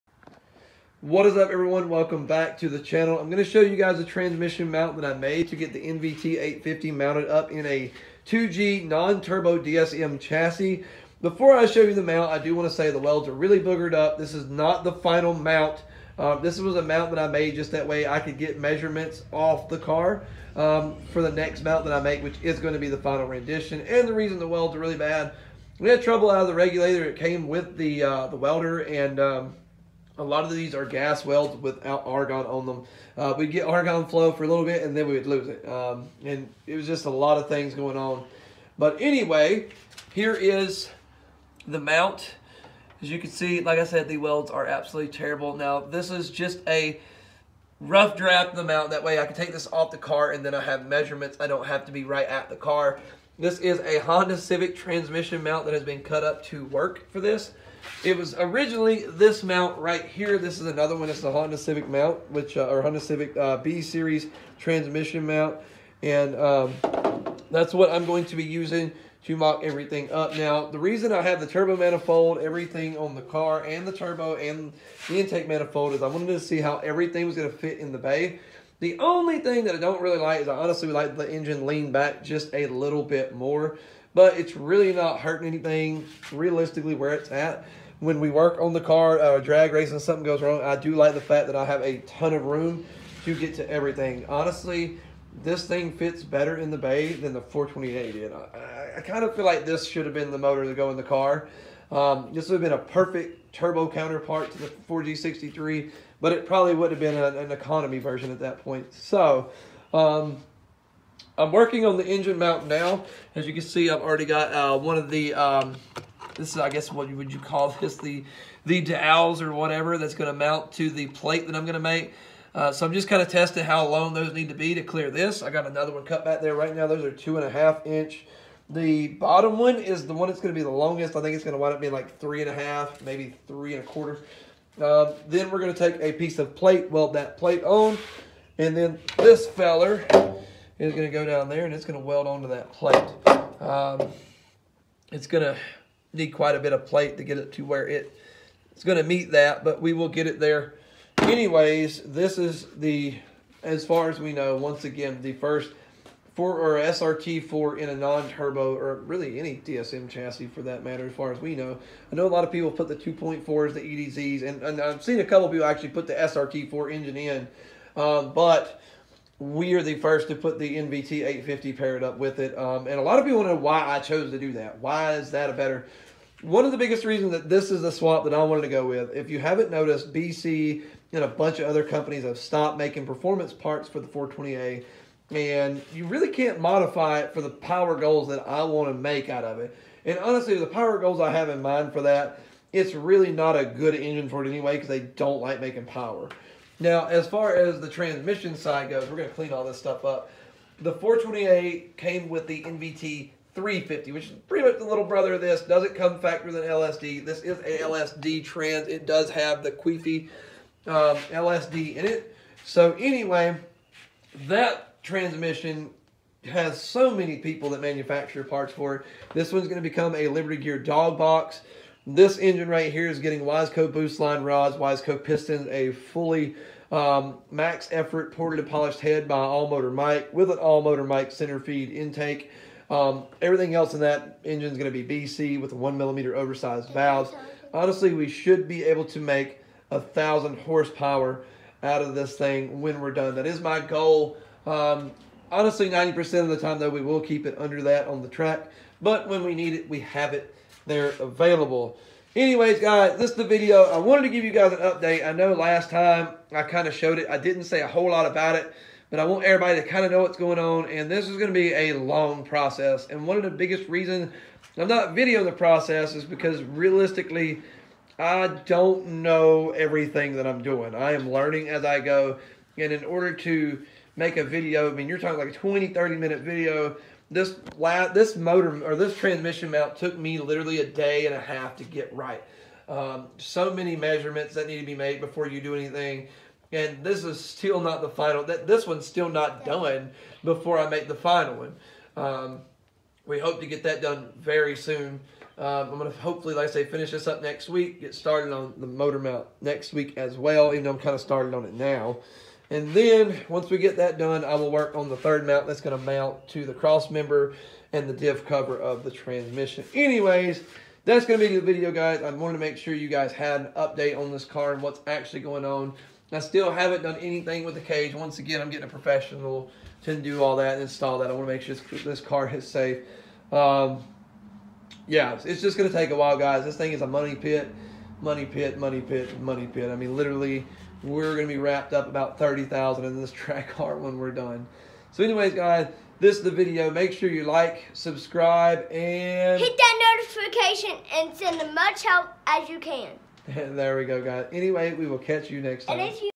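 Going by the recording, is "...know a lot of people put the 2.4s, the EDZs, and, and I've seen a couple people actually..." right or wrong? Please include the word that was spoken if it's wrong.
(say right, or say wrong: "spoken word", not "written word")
right.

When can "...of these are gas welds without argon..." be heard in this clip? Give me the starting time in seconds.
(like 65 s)
30 s.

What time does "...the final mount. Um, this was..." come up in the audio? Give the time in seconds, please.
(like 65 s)
14 s.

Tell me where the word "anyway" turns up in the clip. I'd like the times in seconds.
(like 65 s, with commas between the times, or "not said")
39 s, 151 s, 194 s, 212 s, 252 s, 309 s, 335 s, 344 s.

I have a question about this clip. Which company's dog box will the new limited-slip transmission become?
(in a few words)
Liberty Gear.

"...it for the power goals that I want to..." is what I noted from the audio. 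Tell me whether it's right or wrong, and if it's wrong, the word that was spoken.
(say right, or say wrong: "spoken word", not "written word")
right.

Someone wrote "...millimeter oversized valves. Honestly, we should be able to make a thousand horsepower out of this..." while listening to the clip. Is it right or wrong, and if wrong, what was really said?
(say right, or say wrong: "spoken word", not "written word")
right.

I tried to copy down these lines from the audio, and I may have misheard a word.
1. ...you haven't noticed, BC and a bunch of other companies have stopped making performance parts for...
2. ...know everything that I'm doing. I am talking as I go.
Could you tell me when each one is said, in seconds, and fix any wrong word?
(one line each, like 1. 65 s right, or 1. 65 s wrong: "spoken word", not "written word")
1. 179 s right
2. 269 s wrong: "learning", not "talking".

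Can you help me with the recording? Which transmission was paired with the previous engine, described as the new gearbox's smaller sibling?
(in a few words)
NVT 350.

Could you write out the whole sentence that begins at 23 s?
And the reason the welds are really bad, we had trouble out of the regulator.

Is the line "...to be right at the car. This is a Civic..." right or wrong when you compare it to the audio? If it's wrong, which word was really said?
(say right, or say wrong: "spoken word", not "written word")
wrong: "Honda", not "Civic".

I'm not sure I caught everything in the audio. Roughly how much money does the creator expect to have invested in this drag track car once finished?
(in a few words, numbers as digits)
30,000.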